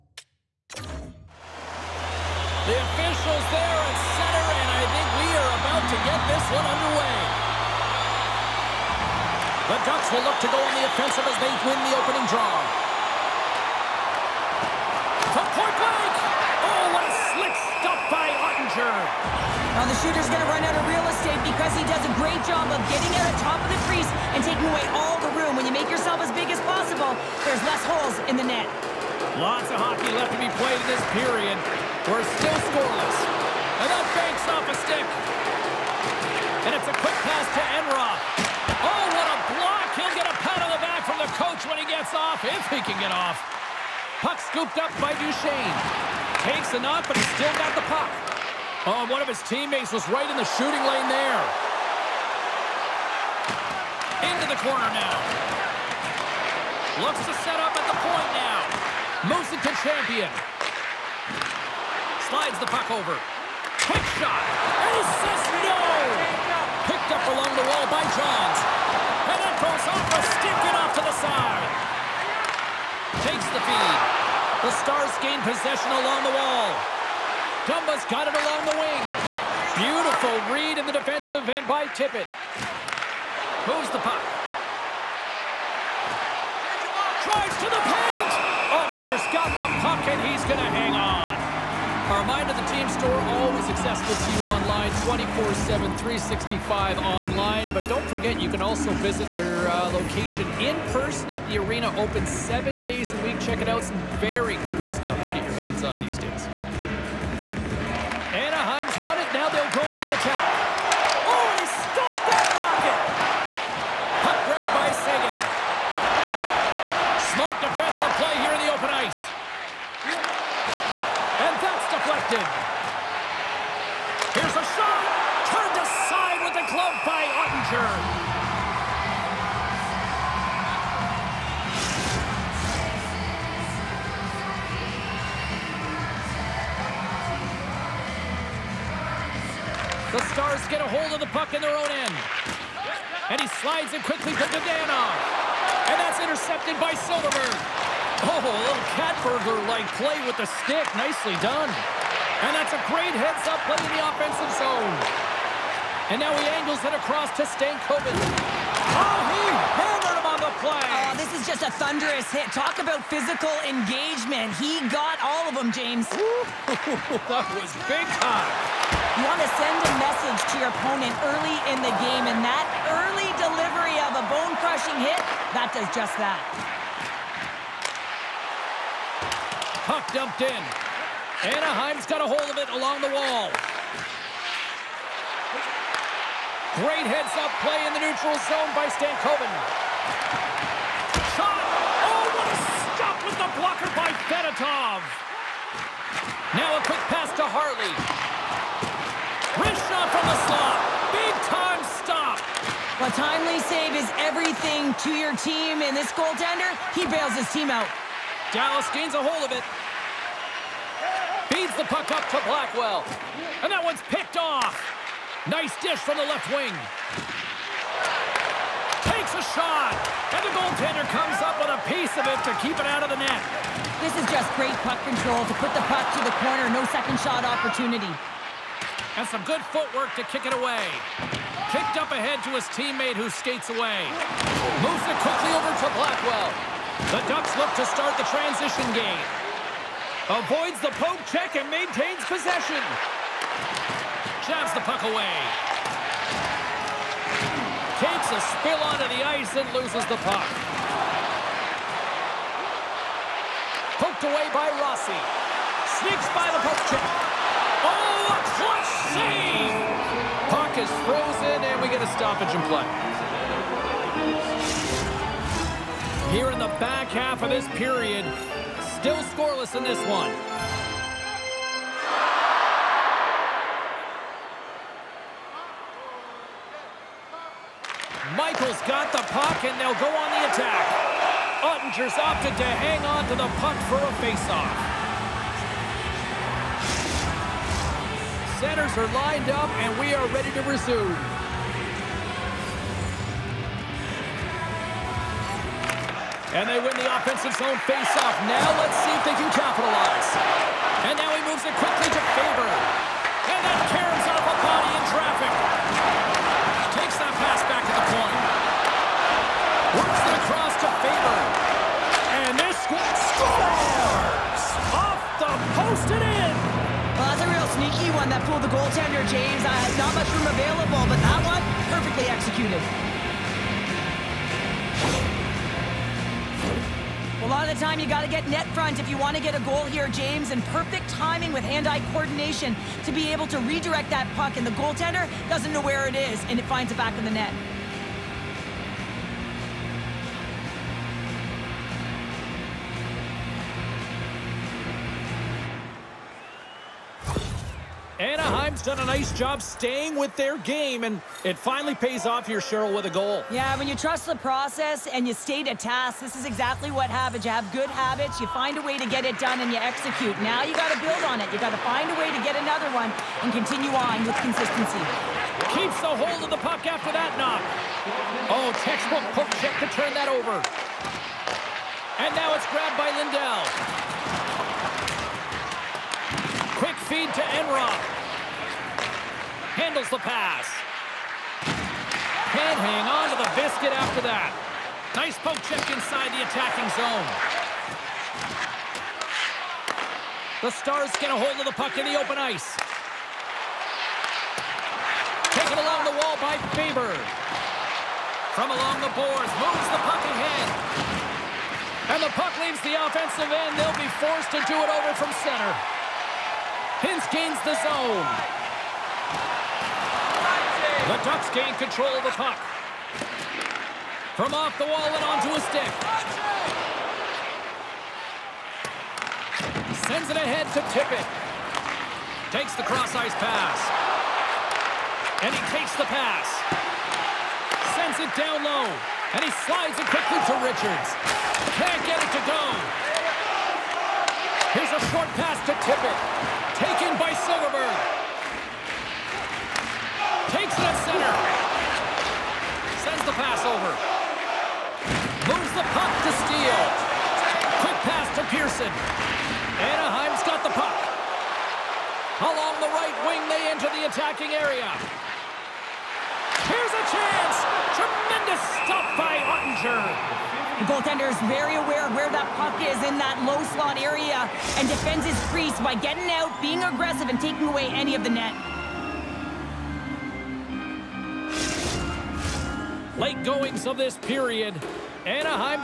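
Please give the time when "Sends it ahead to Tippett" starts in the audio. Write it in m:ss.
7:00.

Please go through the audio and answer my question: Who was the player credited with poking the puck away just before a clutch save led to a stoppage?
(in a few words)
Rossi.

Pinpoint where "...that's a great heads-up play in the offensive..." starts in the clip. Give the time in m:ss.
2:32.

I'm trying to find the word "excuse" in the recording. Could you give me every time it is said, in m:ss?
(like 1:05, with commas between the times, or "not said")
not said.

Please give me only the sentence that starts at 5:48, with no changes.
done a nice job staying with their game, and it finally pays off here, Cheryl, with a goal.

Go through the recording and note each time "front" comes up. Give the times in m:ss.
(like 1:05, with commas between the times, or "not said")
5:28.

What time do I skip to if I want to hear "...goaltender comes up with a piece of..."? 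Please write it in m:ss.
3:40.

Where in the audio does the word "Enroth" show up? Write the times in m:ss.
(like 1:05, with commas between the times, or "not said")
0:37, 6:17.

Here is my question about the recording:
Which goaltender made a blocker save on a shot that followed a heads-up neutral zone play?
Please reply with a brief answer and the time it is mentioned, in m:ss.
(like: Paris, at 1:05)
Fedotov, at 3:14.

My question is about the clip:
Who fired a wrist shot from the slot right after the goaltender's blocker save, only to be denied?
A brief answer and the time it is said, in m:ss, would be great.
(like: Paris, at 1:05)
Hartley, at 3:17.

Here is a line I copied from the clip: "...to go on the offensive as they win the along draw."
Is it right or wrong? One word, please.
wrong.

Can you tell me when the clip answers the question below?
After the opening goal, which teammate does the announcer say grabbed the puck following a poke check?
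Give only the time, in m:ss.
6:13.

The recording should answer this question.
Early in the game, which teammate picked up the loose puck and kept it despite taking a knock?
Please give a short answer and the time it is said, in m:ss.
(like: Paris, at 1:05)
Duchesne, at 0:45.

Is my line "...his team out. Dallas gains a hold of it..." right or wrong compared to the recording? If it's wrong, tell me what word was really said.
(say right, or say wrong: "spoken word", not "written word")
right.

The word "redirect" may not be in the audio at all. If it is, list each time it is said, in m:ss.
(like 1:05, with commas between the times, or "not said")
5:33.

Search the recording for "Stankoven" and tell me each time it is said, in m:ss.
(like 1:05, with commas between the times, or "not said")
2:37, 3:08.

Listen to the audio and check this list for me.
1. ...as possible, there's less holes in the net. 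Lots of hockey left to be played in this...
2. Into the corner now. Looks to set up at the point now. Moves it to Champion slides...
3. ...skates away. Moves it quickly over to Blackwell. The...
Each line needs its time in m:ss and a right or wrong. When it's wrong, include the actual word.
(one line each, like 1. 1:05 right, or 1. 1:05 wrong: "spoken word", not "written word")
1. 0:26 right
2. 0:54 right
3. 3:53 right.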